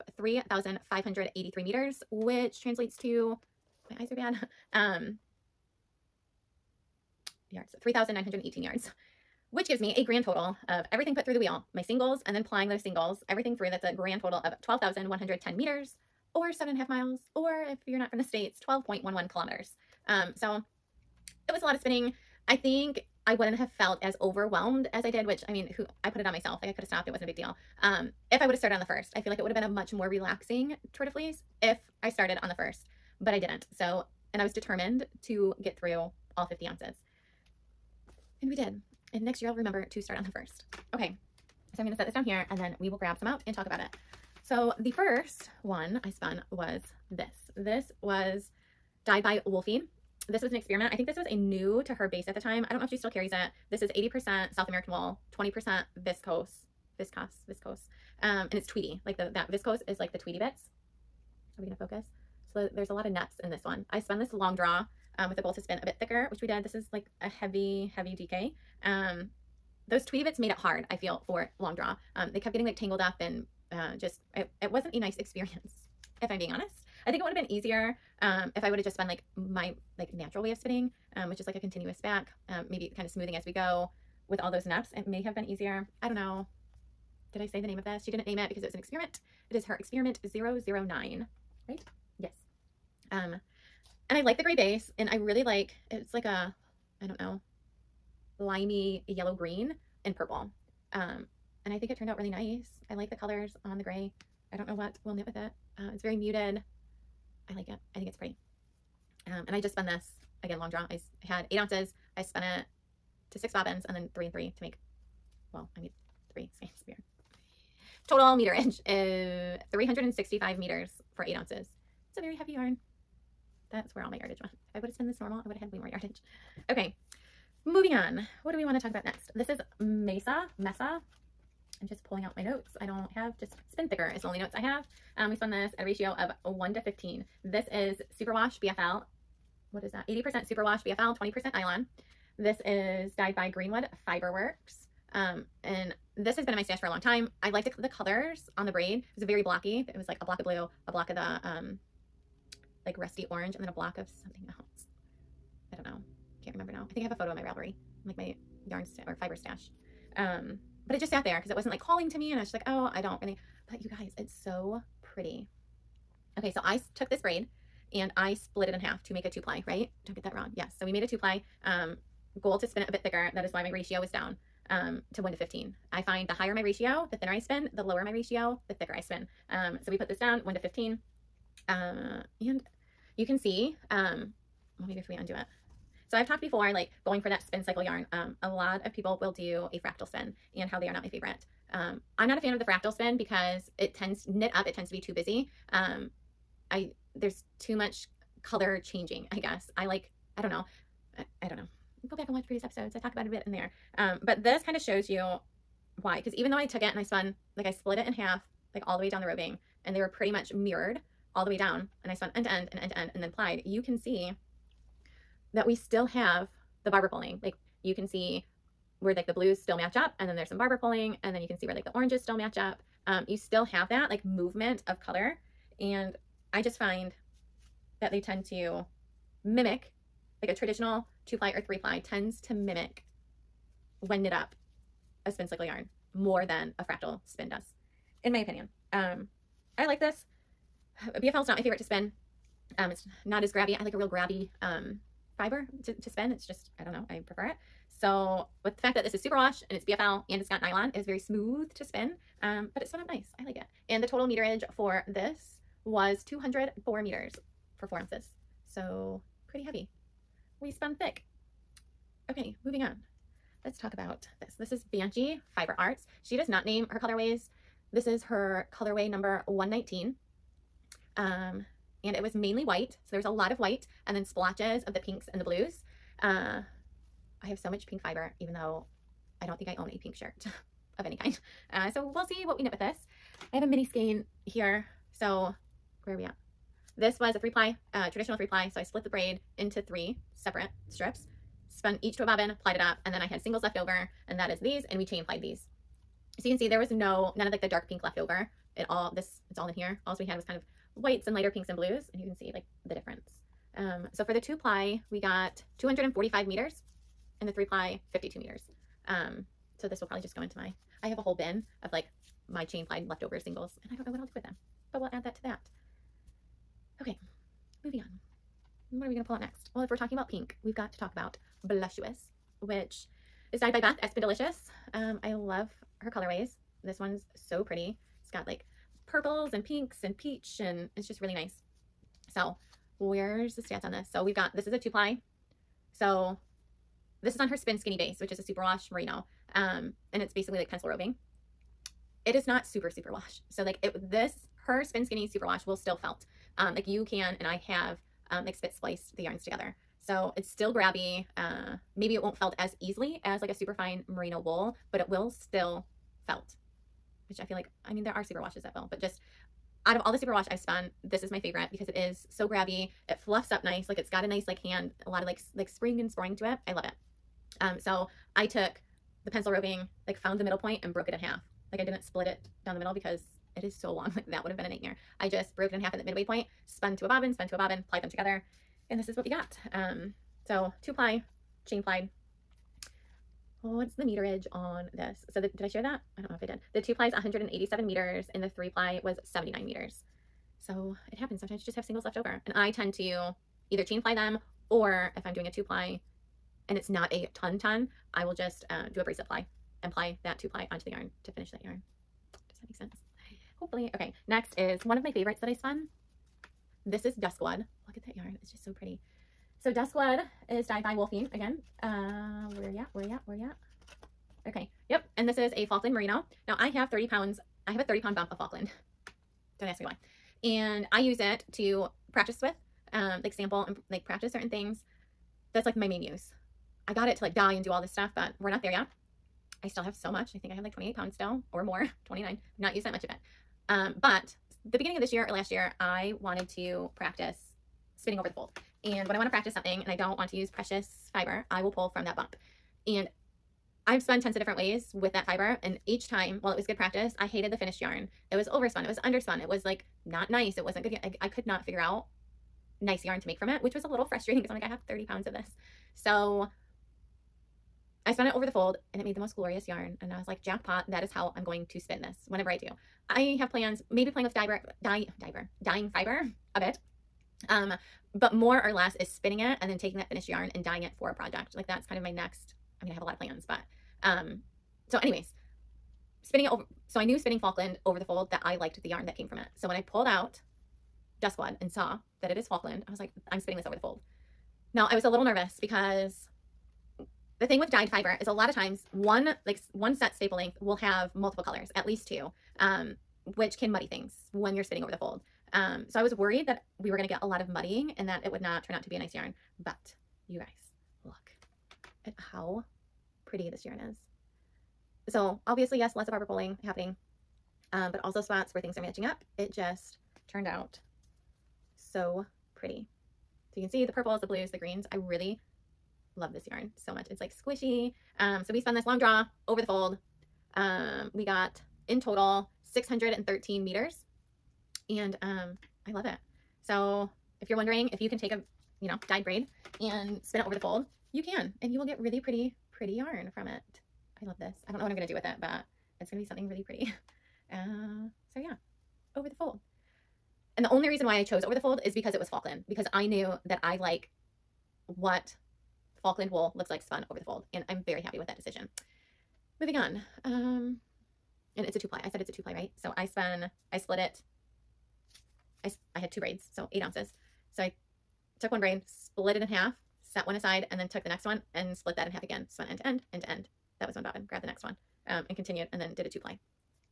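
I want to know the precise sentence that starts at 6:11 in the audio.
Like I didn't split it down the middle because it is so long.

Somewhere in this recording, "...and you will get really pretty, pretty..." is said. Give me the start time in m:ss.
8:51.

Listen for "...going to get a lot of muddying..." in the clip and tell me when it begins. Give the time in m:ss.
8:16.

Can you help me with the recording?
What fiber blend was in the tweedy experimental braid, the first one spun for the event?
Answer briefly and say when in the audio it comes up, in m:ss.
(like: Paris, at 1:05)
80% South American wool, 20% viscose, at 0:53.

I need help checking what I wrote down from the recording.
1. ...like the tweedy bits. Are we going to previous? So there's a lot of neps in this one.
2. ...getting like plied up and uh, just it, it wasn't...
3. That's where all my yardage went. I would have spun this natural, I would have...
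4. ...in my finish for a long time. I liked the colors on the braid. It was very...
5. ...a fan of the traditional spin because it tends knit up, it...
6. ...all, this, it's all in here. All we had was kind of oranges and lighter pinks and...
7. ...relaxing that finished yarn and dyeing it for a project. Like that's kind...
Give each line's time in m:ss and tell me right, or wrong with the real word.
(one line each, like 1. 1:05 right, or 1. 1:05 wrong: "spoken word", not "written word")
1. 0:59 wrong: "focus", not "previous"
2. 1:12 wrong: "tangled", not "plied"
3. 2:03 wrong: "normal", not "natural"
4. 2:26 wrong: "stash", not "finish"
5. 3:12 wrong: "fractal", not "traditional"
6. 4:58 wrong: "whites", not "oranges"
7. 7:49 wrong: "taking", not "relaxing".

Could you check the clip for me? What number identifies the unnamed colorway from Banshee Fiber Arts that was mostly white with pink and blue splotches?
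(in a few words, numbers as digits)
119.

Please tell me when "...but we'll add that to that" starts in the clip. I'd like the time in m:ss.
5:14.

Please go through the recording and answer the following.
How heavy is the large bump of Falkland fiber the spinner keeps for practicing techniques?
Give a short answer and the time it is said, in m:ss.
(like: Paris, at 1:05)
30 pounds, at 6:57.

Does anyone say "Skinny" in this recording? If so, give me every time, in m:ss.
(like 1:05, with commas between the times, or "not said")
5:37, 5:45.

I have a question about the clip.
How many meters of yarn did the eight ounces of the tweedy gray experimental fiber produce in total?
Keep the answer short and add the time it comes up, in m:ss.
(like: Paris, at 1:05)
365 meters, at 1:59.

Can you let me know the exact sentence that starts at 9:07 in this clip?
And I'm very happy with that decision.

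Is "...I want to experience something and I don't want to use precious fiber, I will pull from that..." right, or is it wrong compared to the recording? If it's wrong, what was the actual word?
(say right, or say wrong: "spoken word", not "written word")
wrong: "practice", not "experience".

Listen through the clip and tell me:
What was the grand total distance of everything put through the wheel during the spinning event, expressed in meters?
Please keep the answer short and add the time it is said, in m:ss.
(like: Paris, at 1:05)
12,110 meters, at 0:14.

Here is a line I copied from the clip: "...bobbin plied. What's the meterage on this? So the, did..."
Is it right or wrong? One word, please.
wrong.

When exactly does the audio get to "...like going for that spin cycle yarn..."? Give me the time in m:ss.
3:06.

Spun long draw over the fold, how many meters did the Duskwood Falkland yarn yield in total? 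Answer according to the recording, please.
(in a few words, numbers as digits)
613 meters.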